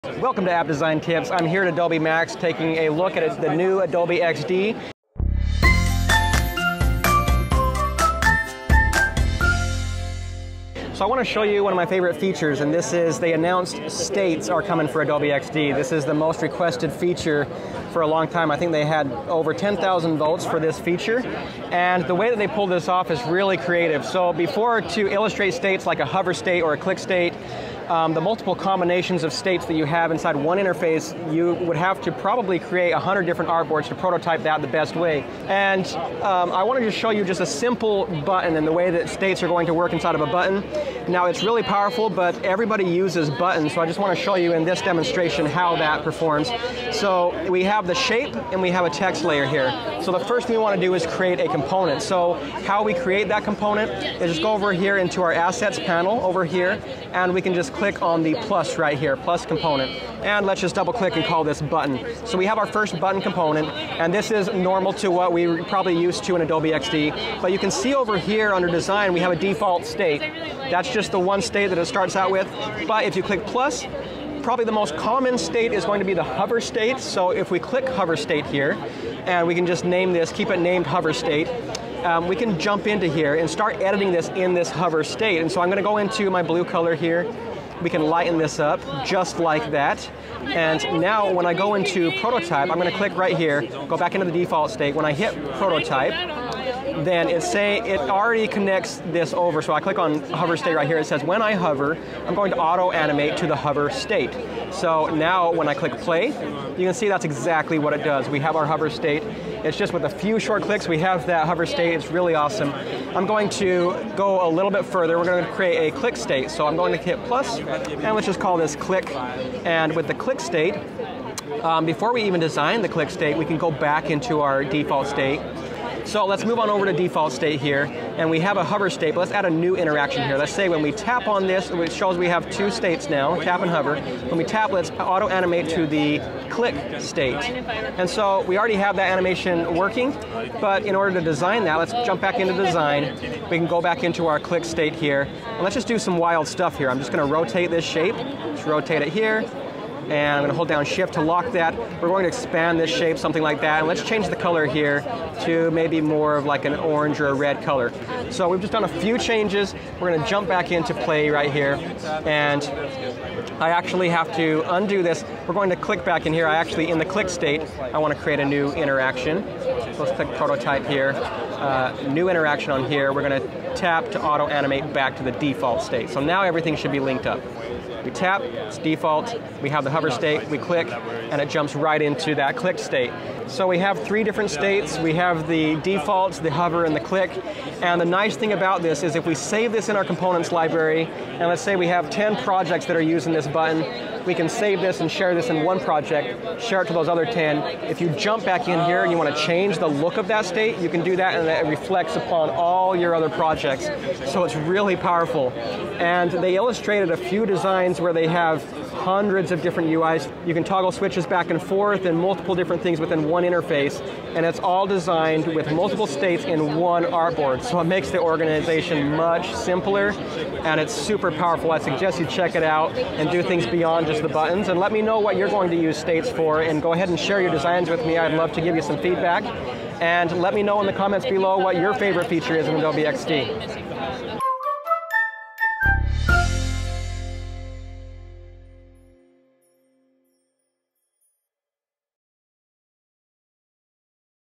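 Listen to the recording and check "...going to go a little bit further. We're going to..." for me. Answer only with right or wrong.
right.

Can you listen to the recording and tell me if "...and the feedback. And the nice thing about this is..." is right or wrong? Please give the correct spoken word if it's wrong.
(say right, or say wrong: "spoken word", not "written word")
wrong: "click", not "feedback".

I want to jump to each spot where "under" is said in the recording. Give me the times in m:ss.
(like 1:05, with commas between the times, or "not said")
1:08.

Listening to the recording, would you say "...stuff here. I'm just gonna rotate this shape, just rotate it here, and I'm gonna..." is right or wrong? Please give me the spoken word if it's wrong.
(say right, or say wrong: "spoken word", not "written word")
right.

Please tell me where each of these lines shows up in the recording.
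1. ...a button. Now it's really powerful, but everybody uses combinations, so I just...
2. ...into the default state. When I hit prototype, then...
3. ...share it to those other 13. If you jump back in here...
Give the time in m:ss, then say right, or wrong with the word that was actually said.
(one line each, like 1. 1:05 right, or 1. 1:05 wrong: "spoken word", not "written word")
1. 0:40 wrong: "buttons", not "combinations"
2. 1:34 right
3. 3:16 wrong: "10", not "13".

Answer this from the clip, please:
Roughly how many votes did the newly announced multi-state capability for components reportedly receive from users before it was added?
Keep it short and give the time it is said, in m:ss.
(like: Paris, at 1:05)
over 10,000, at 0:19.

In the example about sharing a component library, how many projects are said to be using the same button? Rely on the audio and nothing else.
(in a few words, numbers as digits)
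10.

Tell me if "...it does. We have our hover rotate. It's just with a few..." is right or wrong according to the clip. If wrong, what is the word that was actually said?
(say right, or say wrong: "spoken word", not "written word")
wrong: "state", not "rotate".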